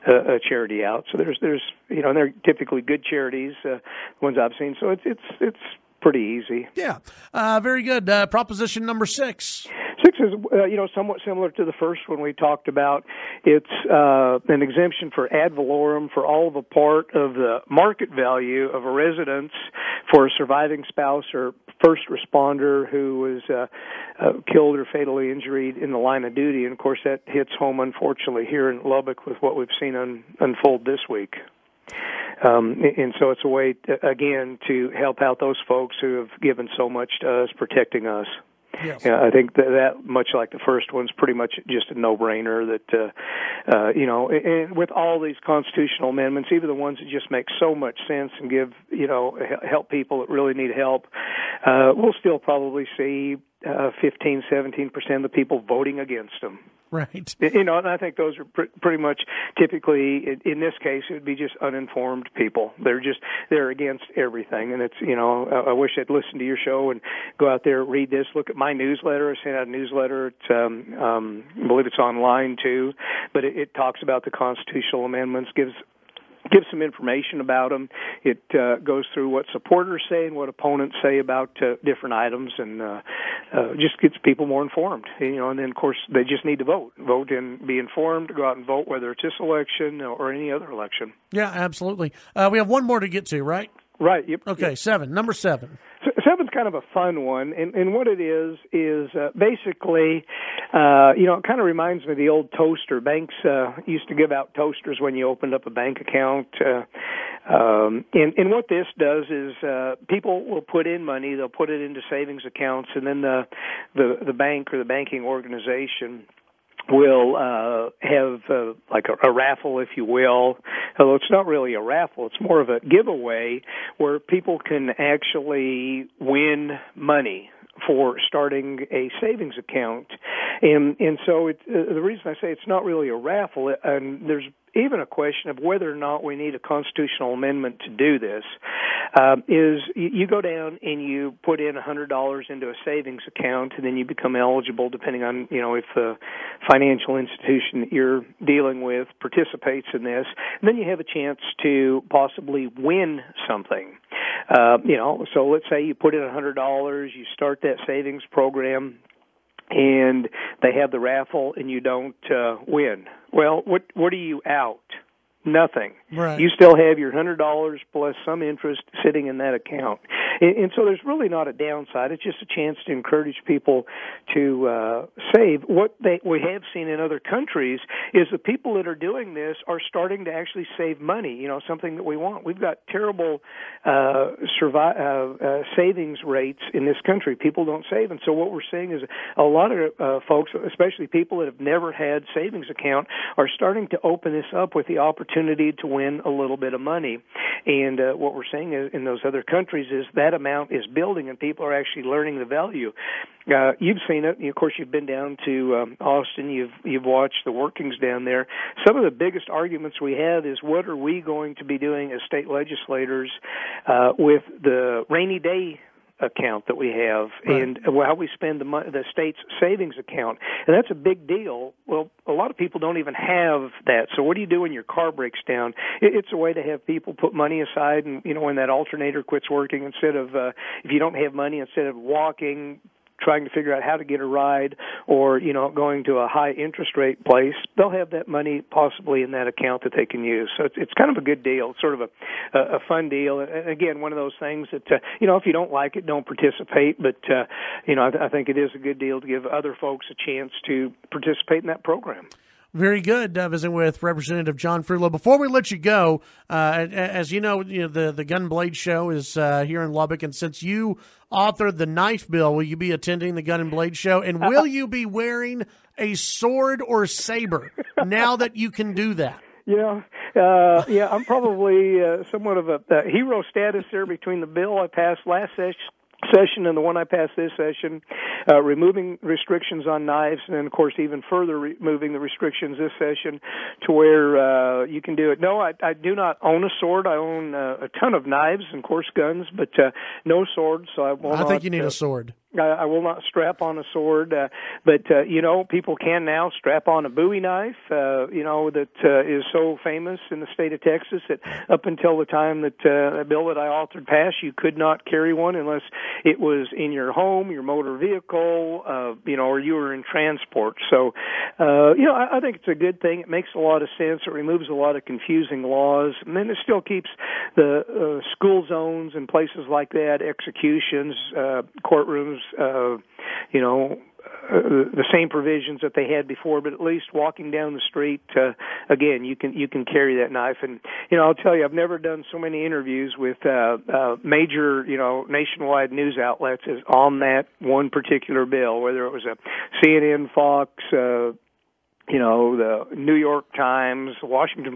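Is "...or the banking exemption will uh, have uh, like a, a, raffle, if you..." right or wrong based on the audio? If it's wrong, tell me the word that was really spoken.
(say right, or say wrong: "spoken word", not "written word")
wrong: "organization", not "exemption".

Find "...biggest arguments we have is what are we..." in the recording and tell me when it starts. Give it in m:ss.
3:29.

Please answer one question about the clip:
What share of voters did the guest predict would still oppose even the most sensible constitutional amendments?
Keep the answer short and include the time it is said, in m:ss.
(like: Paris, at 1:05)
15 to 17 percent, at 0:54.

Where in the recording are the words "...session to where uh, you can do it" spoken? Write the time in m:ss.
4:42.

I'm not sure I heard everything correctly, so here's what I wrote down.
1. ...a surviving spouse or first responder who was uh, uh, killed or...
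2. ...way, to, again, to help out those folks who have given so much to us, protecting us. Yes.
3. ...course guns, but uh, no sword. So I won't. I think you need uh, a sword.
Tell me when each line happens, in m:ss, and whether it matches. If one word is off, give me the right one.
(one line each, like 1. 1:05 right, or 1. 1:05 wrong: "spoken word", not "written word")
1. 0:20 right
2. 0:33 right
3. 4:48 right.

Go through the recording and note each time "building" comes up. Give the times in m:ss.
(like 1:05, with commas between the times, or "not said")
3:20.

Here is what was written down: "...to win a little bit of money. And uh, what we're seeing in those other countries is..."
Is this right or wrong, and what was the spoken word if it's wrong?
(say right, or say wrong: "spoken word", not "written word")
right.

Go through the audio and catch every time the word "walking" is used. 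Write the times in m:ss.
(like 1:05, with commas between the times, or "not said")
3:51, 5:27.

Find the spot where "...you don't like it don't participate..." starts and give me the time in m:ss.
4:05.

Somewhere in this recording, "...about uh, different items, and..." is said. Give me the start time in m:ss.
1:21.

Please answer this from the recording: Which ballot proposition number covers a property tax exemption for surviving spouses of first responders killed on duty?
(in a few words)
6.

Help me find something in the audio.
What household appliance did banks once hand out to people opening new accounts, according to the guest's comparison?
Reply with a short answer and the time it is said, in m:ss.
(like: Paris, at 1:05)
Toasters, at 1:44.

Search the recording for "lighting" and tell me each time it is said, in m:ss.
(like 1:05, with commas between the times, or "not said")
not said.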